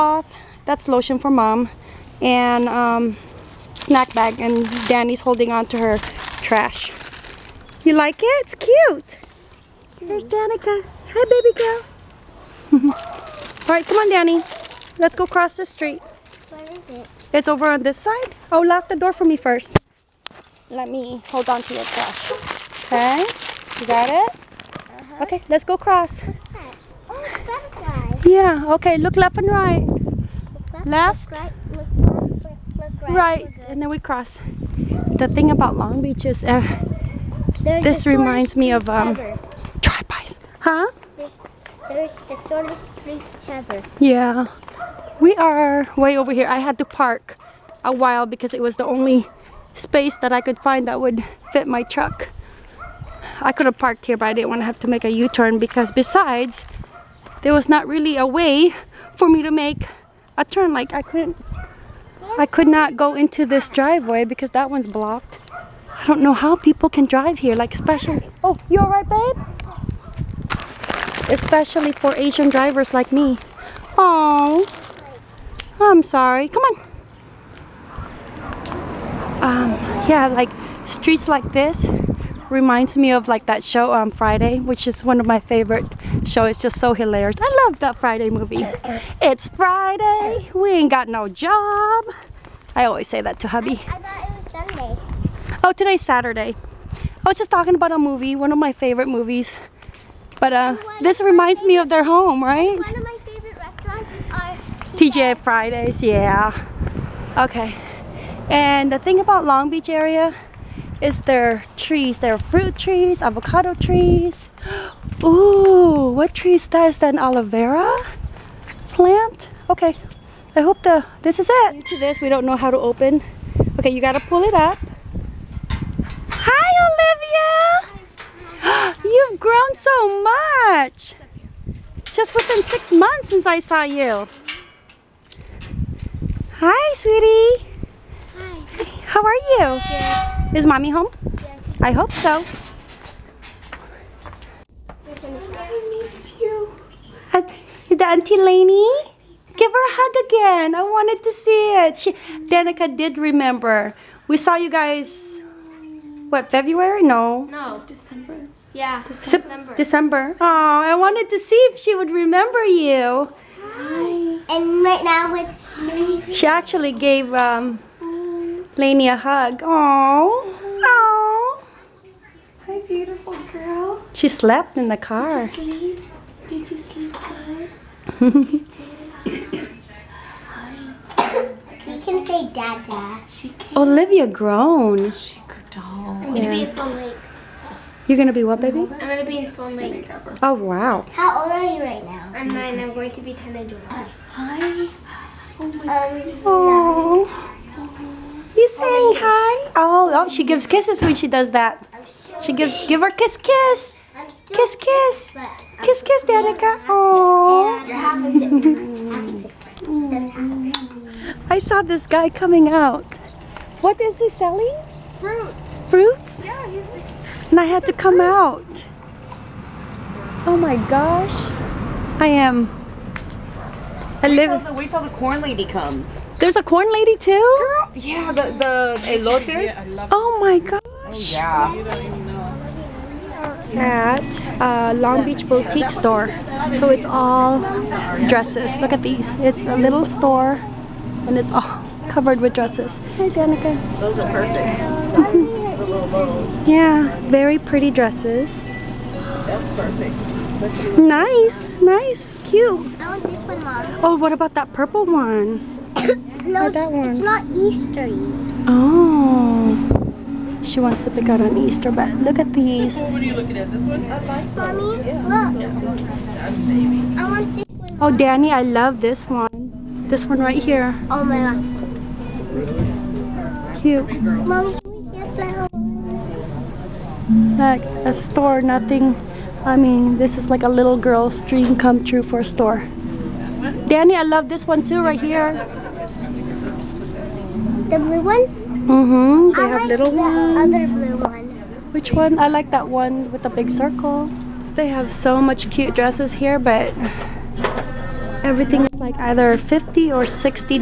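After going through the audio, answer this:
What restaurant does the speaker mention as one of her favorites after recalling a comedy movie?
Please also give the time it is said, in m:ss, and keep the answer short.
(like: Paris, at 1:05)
TJ Fridays, at 1:44.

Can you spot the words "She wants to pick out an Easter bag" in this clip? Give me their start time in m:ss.
4:20.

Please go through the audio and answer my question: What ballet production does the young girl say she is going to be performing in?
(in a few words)
Swan Lake.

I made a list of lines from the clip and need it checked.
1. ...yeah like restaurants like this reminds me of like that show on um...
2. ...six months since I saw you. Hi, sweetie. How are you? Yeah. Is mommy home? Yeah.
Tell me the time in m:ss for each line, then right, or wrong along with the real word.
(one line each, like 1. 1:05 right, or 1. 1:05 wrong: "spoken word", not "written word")
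1. 1:20 wrong: "streets", not "restaurants"
2. 2:12 right.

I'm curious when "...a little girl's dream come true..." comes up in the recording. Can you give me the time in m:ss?
4:40.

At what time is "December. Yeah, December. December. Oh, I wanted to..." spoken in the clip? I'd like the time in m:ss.
2:37.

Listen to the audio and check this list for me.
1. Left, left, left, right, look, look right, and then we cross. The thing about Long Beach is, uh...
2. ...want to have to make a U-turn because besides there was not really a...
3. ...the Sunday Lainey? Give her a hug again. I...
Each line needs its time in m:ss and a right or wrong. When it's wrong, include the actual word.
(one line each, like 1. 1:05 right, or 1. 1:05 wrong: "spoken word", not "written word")
1. 0:30 right
2. 0:54 right
3. 2:27 wrong: "Auntie", not "Sunday".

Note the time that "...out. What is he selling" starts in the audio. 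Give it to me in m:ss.
3:32.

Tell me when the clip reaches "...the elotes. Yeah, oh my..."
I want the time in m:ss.
3:48.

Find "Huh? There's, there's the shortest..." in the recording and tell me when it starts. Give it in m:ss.
0:40.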